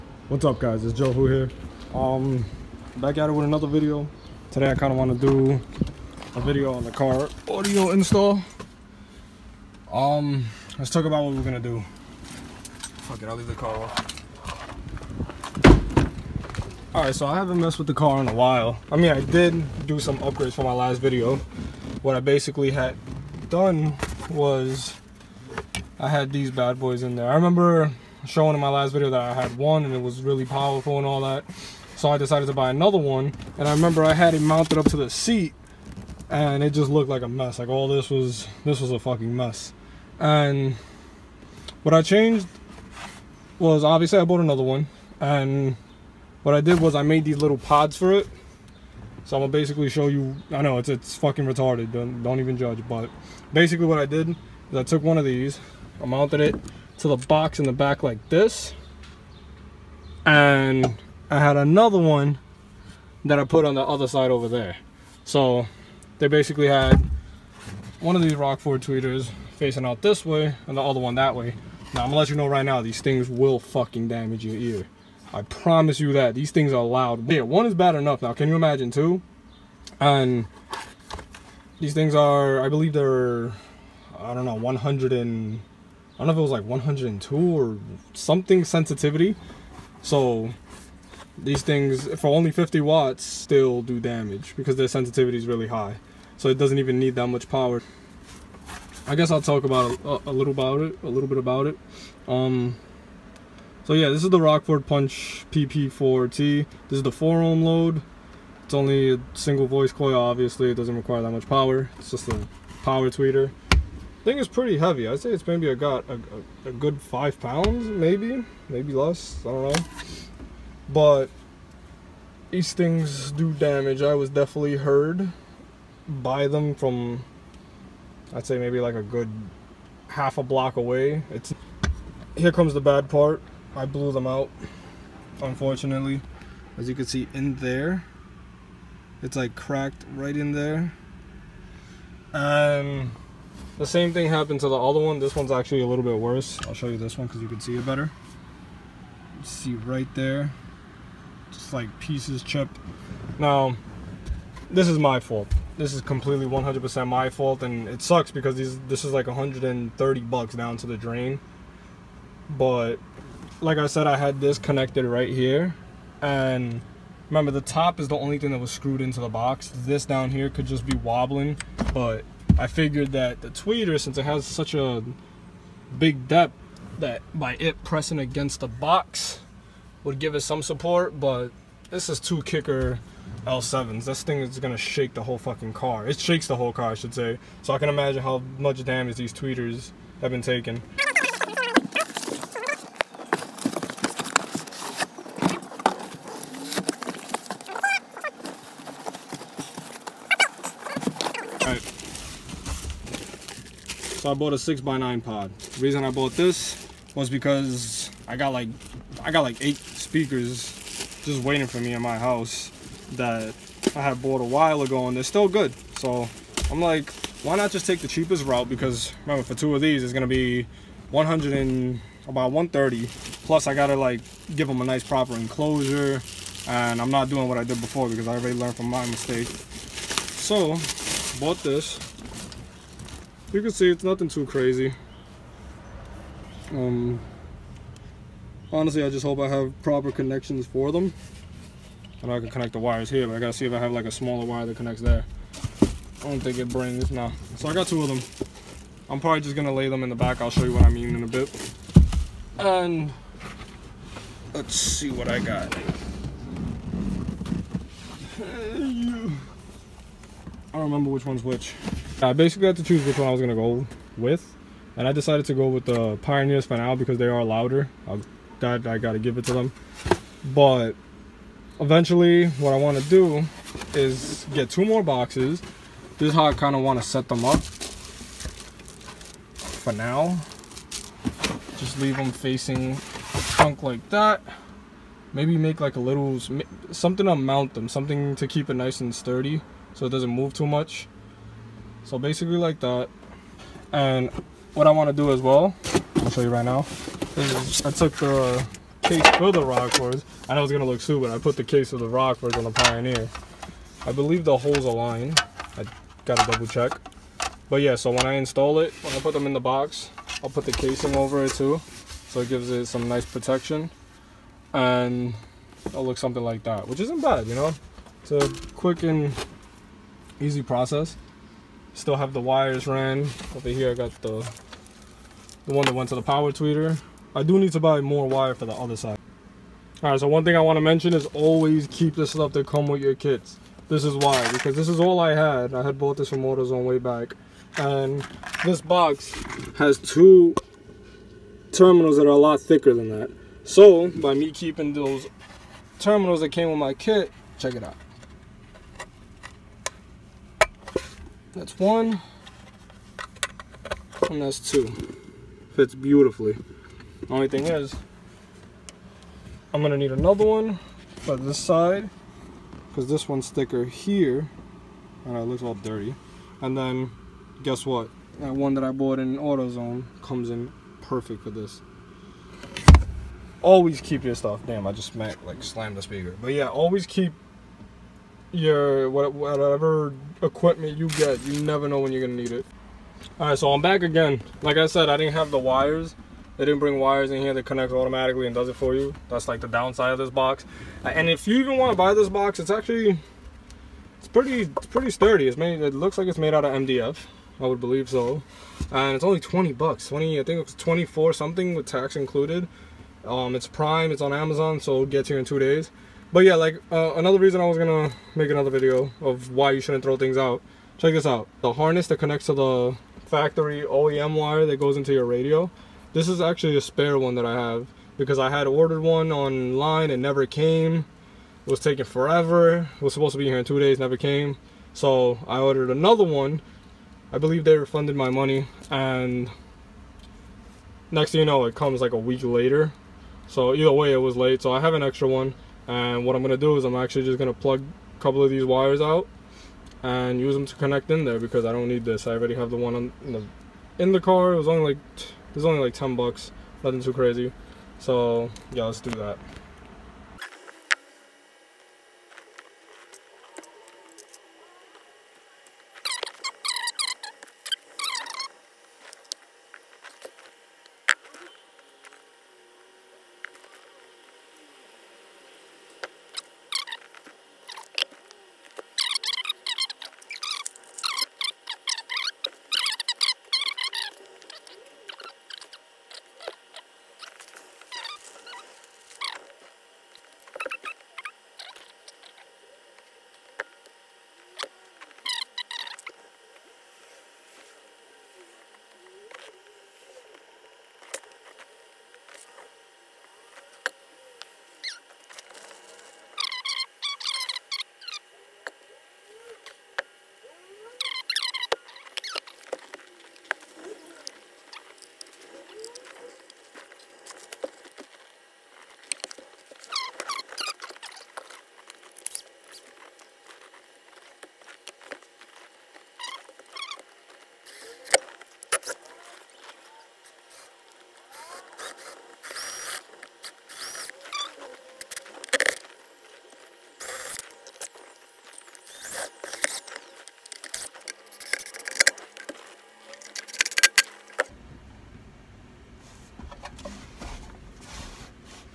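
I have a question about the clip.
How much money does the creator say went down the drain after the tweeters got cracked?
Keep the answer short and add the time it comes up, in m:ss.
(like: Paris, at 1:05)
130 bucks, at 2:39.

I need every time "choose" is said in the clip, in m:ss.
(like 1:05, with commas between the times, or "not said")
4:22.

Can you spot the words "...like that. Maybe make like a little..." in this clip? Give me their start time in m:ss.
4:43.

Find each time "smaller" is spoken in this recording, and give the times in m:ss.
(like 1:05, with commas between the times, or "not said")
4:04.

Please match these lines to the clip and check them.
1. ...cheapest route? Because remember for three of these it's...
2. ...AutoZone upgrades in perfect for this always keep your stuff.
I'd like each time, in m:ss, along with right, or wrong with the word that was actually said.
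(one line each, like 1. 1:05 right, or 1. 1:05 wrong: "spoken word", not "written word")
1. 3:38 wrong: "two", not "three"
2. 6:09 wrong: "comes", not "upgrades".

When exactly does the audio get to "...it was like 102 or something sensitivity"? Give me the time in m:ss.
1:26.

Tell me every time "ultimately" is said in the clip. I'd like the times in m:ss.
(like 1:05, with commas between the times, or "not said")
not said.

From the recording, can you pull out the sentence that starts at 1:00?
And I had another one that I put on the other side over there.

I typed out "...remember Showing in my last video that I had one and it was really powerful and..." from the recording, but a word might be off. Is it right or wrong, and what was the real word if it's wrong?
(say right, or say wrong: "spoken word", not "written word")
right.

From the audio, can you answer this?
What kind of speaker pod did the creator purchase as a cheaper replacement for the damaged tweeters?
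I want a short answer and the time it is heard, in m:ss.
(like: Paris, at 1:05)
6x9 pod, at 3:24.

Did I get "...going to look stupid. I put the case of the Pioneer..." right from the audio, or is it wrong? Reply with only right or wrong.
wrong.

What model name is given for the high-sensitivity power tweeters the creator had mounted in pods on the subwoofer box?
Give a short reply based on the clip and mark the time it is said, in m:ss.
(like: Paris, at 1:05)
Rockford Punch PP4T, at 1:44.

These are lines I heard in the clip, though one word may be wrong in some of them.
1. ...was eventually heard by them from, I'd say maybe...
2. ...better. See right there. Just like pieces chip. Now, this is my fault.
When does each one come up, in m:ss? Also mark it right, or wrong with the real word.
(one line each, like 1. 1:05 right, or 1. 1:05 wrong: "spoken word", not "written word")
1. 2:04 wrong: "definitely", not "eventually"
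2. 2:27 right.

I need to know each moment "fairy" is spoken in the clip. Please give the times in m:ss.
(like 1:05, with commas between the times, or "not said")
not said.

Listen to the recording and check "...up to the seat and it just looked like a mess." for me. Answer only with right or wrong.
right.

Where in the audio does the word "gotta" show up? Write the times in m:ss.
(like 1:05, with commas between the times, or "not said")
3:43, 4:03, 4:28.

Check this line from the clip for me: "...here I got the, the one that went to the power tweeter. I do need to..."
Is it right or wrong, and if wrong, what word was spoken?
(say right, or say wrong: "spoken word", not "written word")
right.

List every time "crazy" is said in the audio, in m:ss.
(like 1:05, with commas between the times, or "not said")
3:54, 7:27.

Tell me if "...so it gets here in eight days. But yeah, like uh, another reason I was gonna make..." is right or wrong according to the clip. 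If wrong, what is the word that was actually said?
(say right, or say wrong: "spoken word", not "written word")
wrong: "two", not "eight".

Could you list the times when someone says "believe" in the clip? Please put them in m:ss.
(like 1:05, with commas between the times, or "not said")
1:22, 5:04, 6:37, 7:07.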